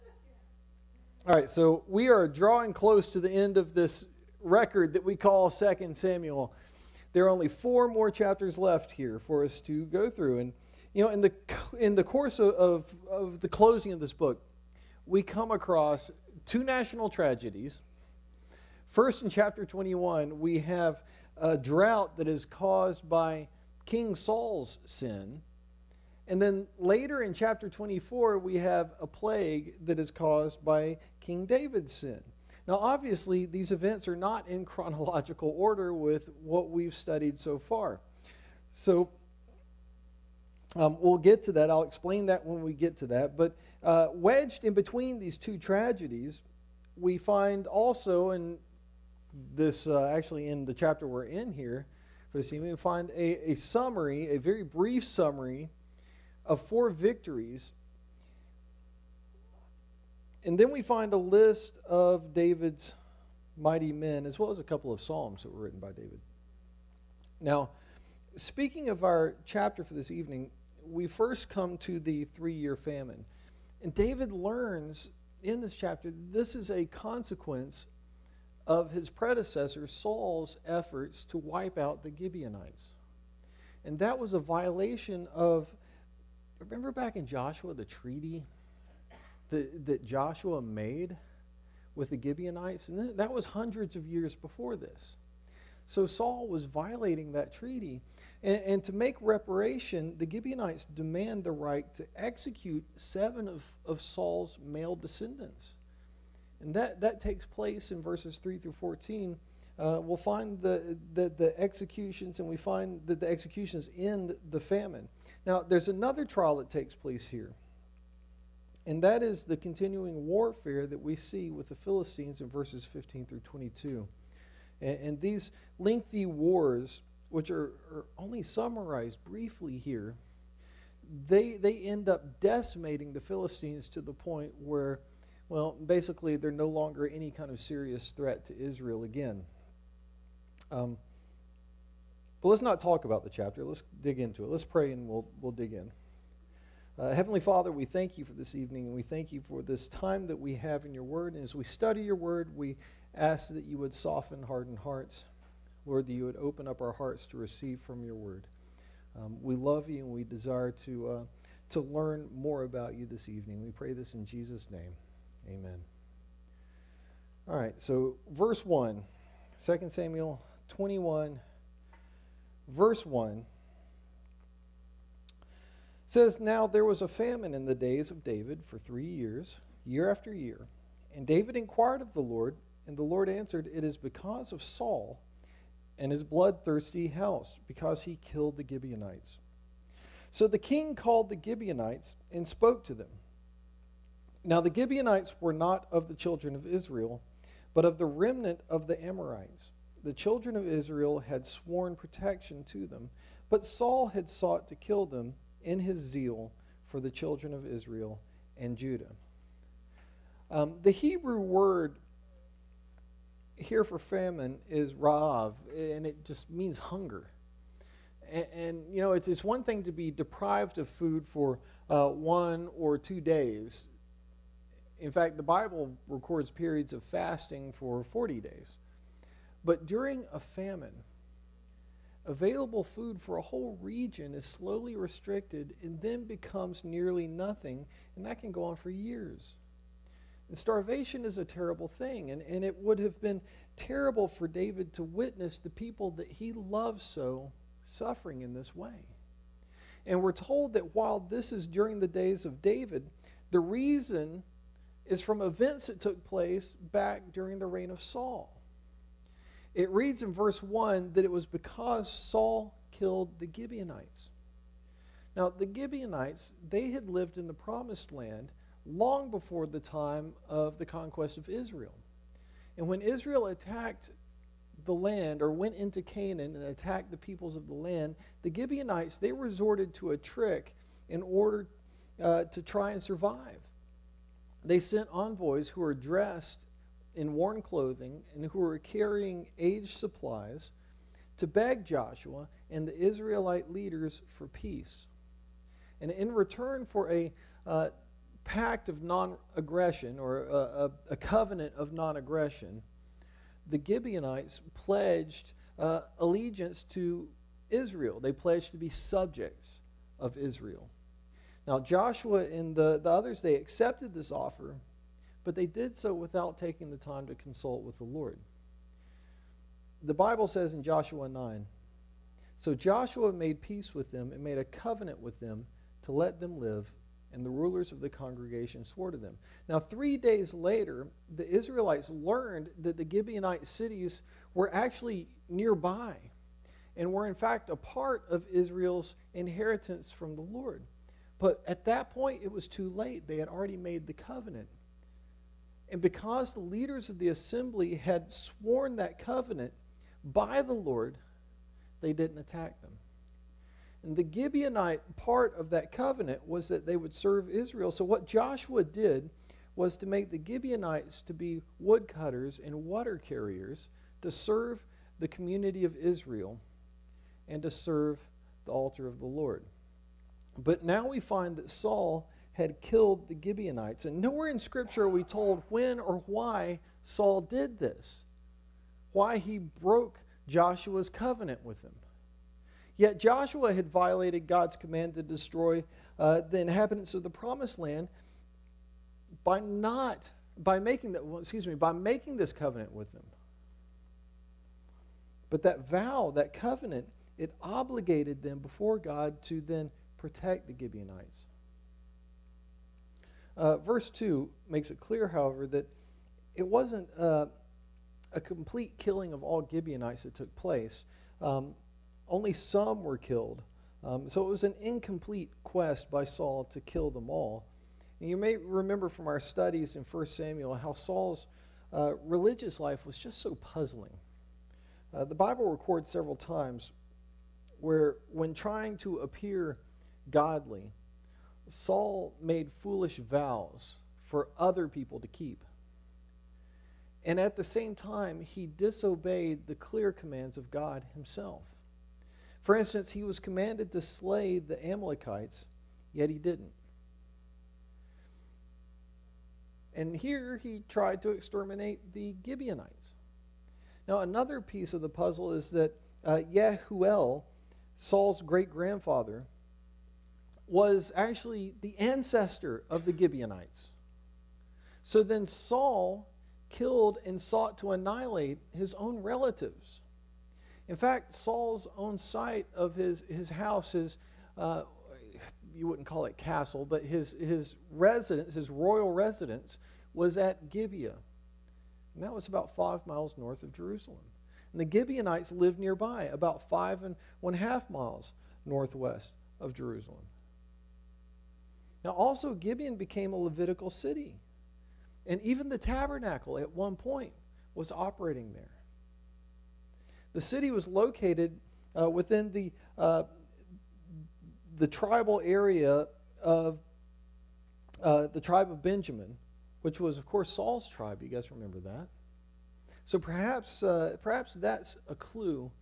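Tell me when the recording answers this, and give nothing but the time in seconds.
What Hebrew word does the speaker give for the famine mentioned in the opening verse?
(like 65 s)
214 s.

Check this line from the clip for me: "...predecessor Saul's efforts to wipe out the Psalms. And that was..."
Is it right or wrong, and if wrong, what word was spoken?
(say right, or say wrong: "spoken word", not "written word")
wrong: "Gibeonites", not "Psalms".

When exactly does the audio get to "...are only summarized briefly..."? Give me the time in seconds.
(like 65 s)
127 s.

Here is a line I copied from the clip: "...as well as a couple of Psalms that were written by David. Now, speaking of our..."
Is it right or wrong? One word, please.
right.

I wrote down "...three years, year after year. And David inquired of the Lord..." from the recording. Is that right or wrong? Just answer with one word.
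right.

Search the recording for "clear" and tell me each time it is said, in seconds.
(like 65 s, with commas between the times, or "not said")
404 s, 439 s.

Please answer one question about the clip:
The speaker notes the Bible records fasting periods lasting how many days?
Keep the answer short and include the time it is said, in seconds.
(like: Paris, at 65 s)
40, at 228 s.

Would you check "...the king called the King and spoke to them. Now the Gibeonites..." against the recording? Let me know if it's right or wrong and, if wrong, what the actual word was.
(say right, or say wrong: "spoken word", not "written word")
wrong: "Gibeonites", not "King".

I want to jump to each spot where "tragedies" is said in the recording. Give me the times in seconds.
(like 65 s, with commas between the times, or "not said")
17 s, 45 s.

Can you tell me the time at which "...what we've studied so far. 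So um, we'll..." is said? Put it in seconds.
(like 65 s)
36 s.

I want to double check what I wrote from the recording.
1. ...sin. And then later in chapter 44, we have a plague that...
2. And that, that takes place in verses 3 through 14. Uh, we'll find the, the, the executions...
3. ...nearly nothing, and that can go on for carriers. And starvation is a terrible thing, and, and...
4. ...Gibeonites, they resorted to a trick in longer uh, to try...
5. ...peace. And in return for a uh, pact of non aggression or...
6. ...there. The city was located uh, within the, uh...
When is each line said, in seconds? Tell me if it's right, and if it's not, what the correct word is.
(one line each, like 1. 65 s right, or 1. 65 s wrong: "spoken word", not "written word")
1. 24 s wrong: "24", not "44"
2. 106 s right
3. 236 s wrong: "years", not "carriers"
4. 278 s wrong: "order", not "longer"
5. 294 s right
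6. 498 s right.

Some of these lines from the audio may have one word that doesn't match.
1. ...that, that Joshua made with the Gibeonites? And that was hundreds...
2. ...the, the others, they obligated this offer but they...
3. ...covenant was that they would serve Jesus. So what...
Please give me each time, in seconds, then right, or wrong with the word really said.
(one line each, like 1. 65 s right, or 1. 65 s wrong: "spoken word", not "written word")
1. 89 s right
2. 312 s wrong: "accepted", not "obligated"
3. 355 s wrong: "Israel", not "Jesus".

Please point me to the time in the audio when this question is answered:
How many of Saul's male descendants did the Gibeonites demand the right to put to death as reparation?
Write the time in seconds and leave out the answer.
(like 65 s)
102 s.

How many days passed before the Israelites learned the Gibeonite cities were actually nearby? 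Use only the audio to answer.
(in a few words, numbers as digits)
3.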